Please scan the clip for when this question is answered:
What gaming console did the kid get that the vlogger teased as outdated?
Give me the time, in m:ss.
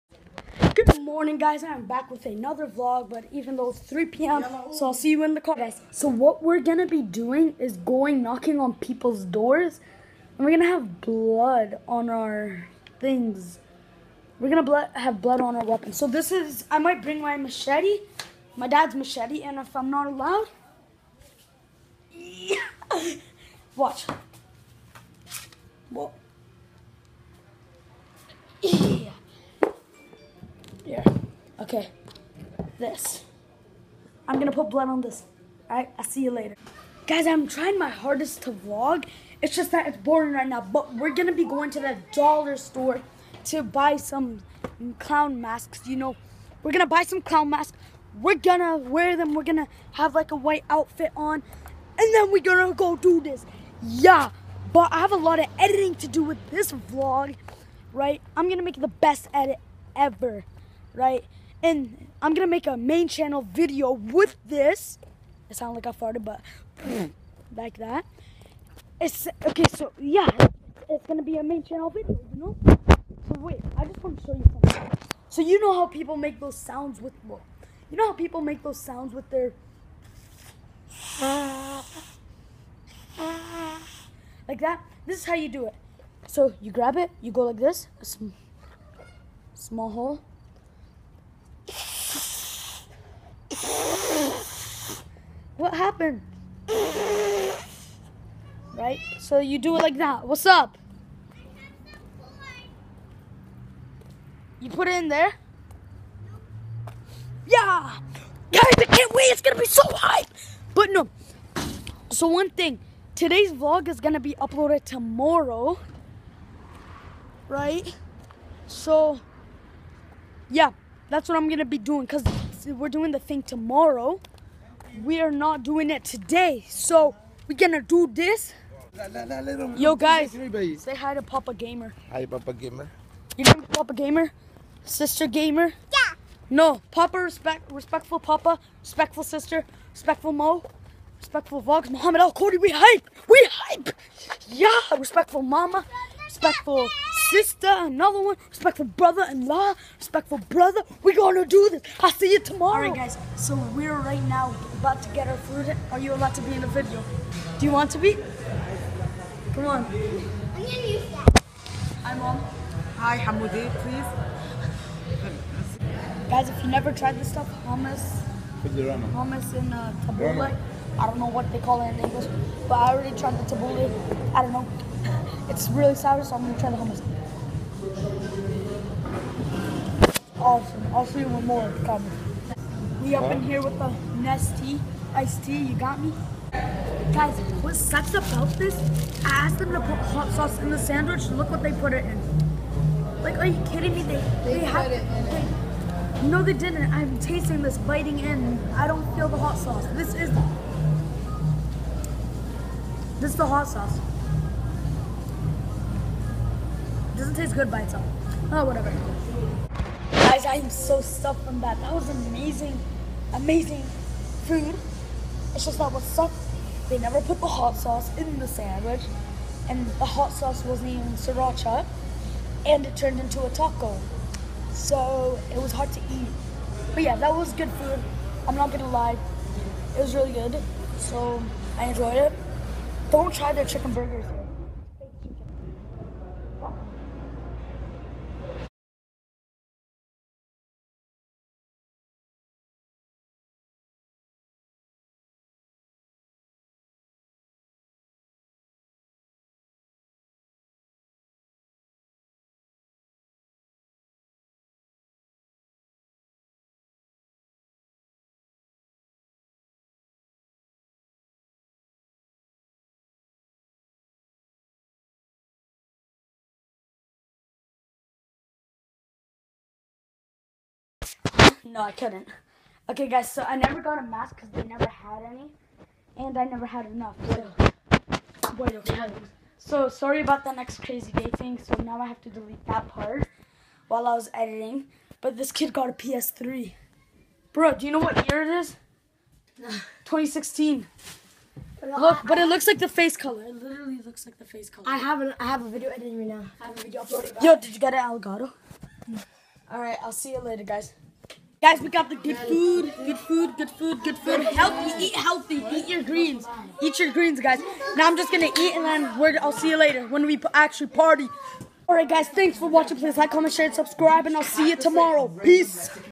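4:45.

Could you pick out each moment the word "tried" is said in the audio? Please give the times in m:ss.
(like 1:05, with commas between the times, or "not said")
2:46, 2:53.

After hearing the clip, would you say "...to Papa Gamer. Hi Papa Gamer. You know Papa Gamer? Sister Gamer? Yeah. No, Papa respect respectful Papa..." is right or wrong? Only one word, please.
right.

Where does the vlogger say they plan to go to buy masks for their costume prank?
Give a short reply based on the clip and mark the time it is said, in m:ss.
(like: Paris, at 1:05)
the dollar store, at 0:41.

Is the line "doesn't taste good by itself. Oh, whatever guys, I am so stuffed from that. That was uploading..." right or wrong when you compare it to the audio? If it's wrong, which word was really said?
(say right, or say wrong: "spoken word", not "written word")
wrong: "amazing", not "uploading".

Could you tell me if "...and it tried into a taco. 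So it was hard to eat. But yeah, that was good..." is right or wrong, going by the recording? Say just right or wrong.
wrong.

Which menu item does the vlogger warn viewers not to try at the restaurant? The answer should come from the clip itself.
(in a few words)
chicken burgers.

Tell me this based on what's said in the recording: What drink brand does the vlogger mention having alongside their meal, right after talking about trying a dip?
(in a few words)
Nestea.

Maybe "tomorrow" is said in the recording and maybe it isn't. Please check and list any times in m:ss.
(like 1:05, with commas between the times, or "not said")
1:54, 2:03, 2:32, 5:14.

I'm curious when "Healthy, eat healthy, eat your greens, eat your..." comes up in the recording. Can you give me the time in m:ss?
5:04.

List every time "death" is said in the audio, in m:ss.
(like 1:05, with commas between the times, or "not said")
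not said.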